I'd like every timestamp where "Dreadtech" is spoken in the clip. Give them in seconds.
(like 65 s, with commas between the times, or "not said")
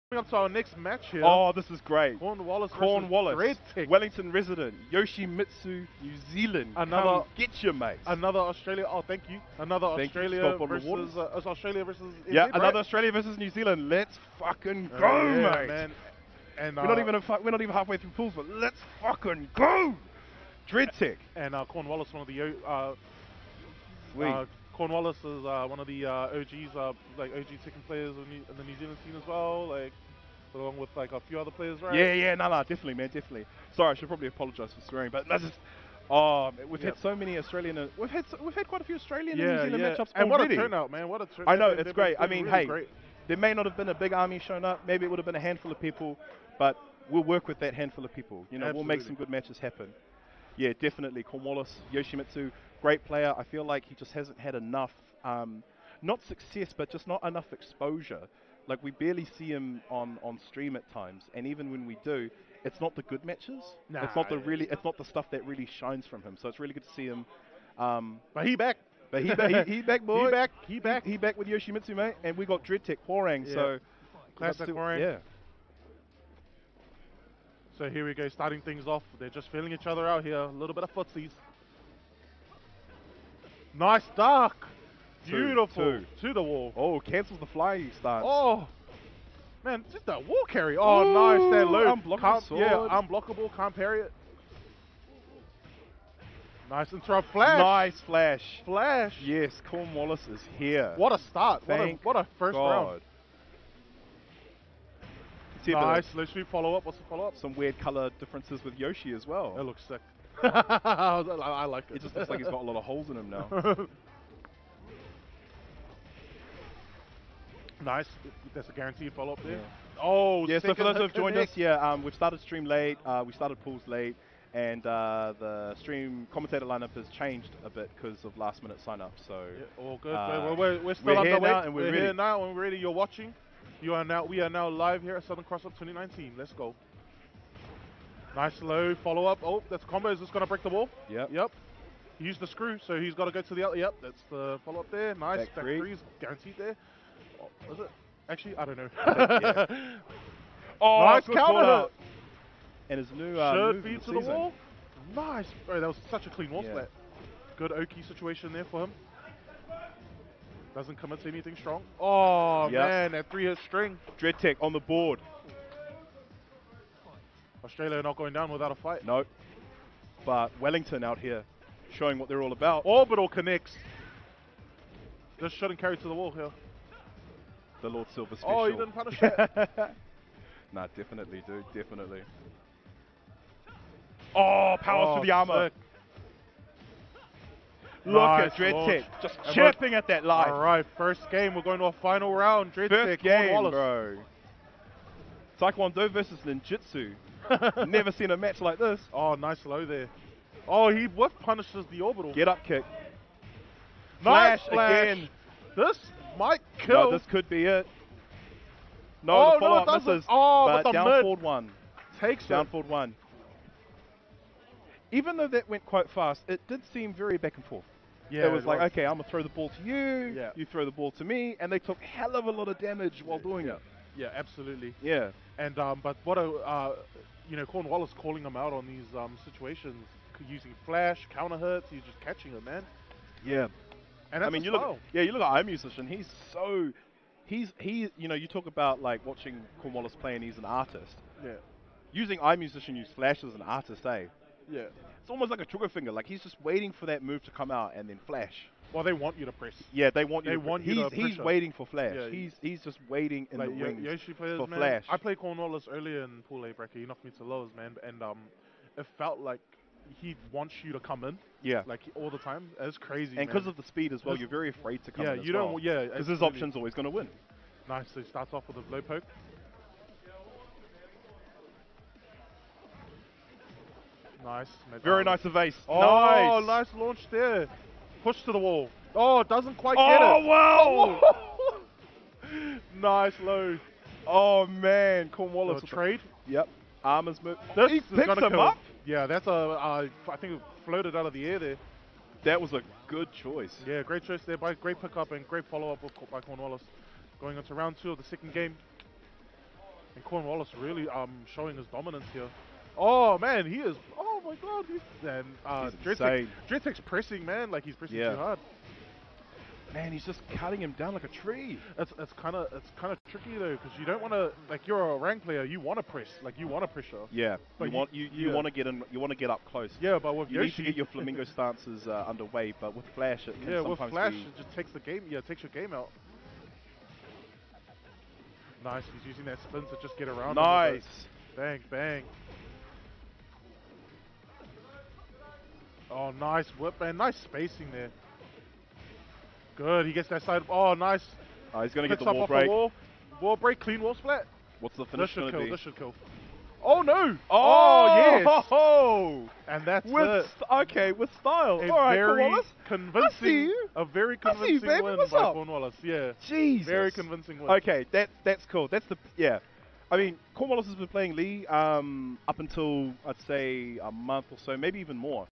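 72 s, 164 s, 188 s, 192 s, 306 s.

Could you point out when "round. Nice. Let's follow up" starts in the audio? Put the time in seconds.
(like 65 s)
102 s.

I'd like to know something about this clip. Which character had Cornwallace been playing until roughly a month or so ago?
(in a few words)
Lee.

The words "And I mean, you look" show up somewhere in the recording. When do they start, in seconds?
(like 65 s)
234 s.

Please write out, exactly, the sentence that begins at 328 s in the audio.
Nice, he's using that spin to just get around.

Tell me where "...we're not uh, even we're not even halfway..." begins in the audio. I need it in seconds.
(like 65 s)
16 s.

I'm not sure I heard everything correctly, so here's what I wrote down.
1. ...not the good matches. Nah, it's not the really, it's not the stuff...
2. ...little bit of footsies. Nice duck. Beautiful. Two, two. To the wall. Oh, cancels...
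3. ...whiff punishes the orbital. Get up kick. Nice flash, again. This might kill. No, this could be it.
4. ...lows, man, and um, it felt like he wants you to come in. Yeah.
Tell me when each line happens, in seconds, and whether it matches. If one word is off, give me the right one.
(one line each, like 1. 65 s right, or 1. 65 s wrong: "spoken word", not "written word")
1. 62 s right
2. 80 s right
3. 201 s right
4. 257 s right.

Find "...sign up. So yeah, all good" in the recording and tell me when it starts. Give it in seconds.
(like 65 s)
128 s.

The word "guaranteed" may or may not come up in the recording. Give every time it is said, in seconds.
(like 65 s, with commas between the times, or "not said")
118 s, 146 s.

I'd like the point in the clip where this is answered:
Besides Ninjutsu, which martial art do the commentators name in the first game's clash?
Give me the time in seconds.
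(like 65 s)
195 s.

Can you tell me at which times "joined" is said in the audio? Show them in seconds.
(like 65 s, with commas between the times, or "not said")
121 s.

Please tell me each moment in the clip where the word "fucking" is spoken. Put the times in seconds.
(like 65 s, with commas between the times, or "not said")
14 s, 19 s.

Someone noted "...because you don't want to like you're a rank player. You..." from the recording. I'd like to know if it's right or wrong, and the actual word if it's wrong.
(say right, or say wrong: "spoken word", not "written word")
right.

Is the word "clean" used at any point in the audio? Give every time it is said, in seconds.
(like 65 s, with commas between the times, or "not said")
156 s, 343 s.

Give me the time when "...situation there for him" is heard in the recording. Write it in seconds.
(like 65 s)
158 s.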